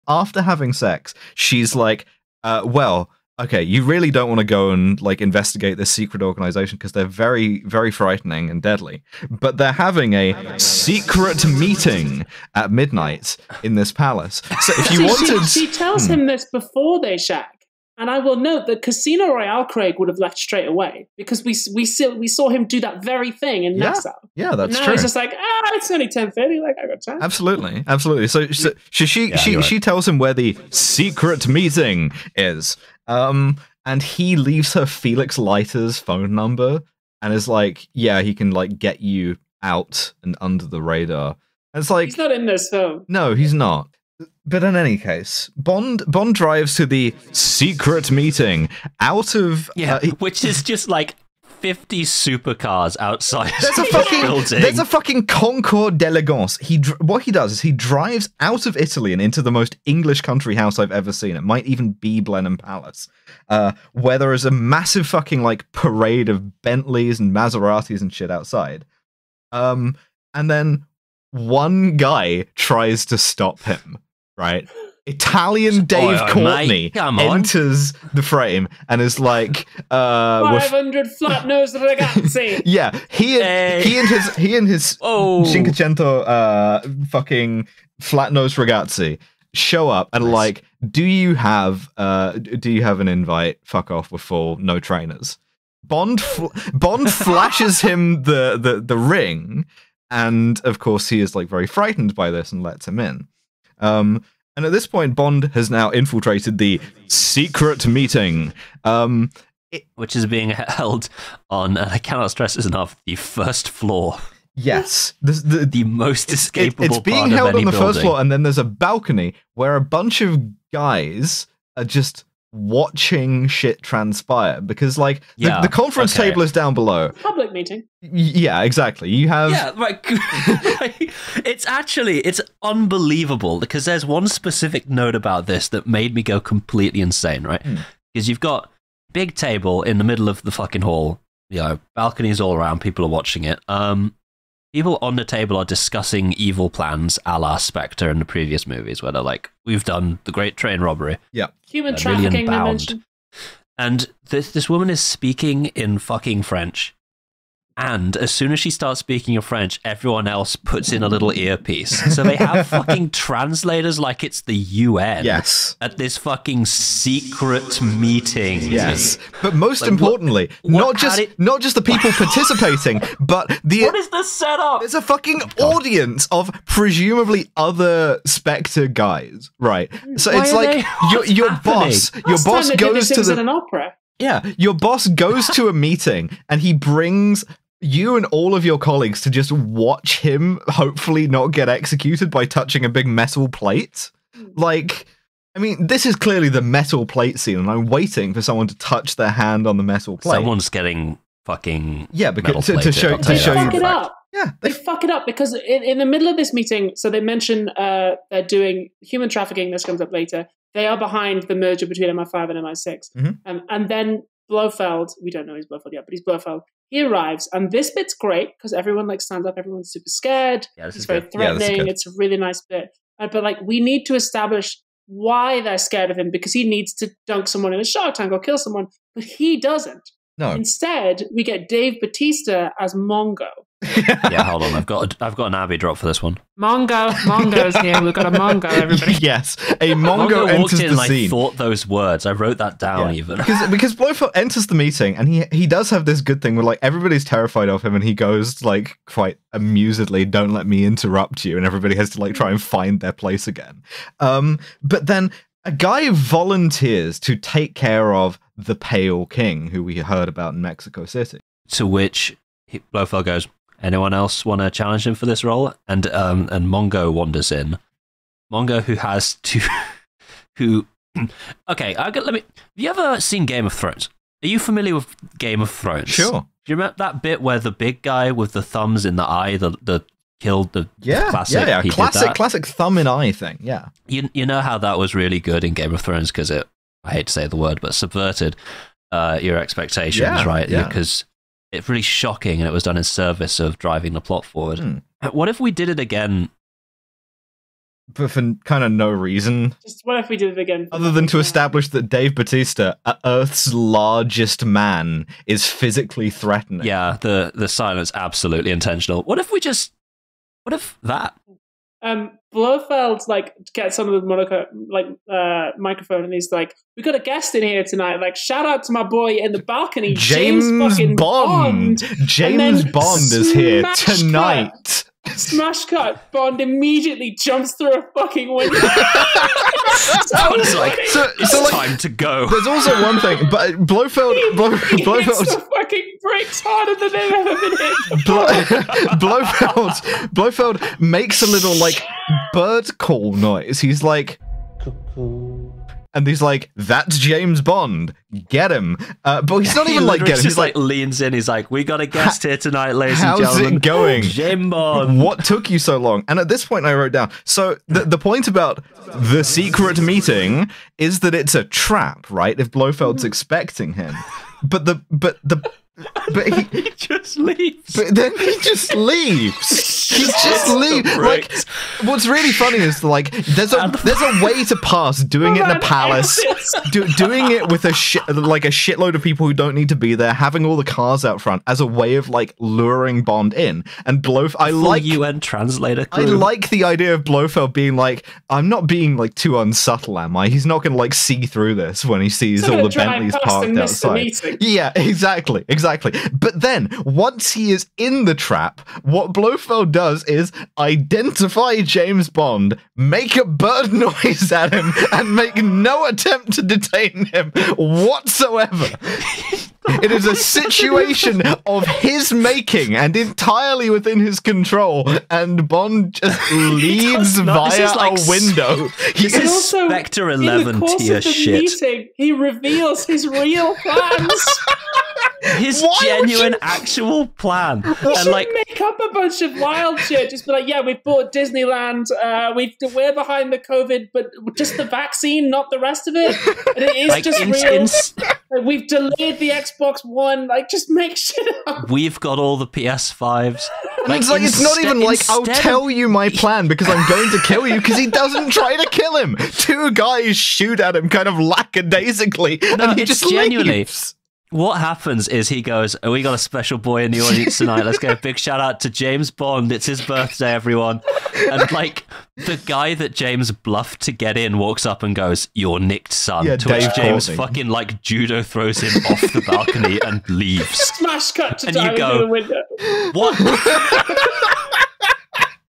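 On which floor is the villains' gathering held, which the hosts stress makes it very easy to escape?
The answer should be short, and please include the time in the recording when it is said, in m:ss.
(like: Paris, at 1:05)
The first floor, at 1:53.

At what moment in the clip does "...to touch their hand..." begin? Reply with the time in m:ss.
3:18.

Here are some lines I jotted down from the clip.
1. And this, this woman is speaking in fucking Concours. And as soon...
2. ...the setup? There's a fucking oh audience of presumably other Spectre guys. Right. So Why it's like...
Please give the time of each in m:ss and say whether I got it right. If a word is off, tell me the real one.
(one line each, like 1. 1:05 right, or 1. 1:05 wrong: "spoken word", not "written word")
1. 2:33 wrong: "French", not "Concours"
2. 2:54 right.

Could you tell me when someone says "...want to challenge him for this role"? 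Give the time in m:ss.
4:24.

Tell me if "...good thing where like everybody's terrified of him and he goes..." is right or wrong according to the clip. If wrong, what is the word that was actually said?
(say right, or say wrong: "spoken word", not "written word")
right.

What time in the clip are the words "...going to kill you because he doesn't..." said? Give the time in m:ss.
7:27.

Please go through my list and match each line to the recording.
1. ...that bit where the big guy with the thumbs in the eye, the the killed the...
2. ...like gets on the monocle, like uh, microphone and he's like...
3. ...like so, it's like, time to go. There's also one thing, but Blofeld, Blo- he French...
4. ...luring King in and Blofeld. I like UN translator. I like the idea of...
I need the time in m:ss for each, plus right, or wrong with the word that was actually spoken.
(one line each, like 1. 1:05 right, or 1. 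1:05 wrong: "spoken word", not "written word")
1. 4:36 right
2. 5:13 right
3. 5:30 wrong: "Blofeld", not "French"
4. 6:22 wrong: "Bond", not "King".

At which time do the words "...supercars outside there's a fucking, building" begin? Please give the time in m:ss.
0:52.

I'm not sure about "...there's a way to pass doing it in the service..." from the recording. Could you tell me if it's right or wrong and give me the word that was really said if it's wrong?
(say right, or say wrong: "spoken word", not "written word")
wrong: "palace", not "service".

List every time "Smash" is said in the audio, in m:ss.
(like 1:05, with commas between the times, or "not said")
5:25, 7:50.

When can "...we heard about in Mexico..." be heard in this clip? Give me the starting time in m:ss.
4:19.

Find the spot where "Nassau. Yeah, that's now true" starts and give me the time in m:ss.
0:23.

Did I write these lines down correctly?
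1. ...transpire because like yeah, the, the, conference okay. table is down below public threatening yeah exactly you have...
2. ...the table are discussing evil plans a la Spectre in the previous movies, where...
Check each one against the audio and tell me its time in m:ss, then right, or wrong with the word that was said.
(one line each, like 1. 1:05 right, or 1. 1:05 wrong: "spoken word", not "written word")
1. 2:03 wrong: "meeting", not "threatening"
2. 2:25 right.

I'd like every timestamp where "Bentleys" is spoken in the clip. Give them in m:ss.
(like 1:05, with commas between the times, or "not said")
1:06, 6:32.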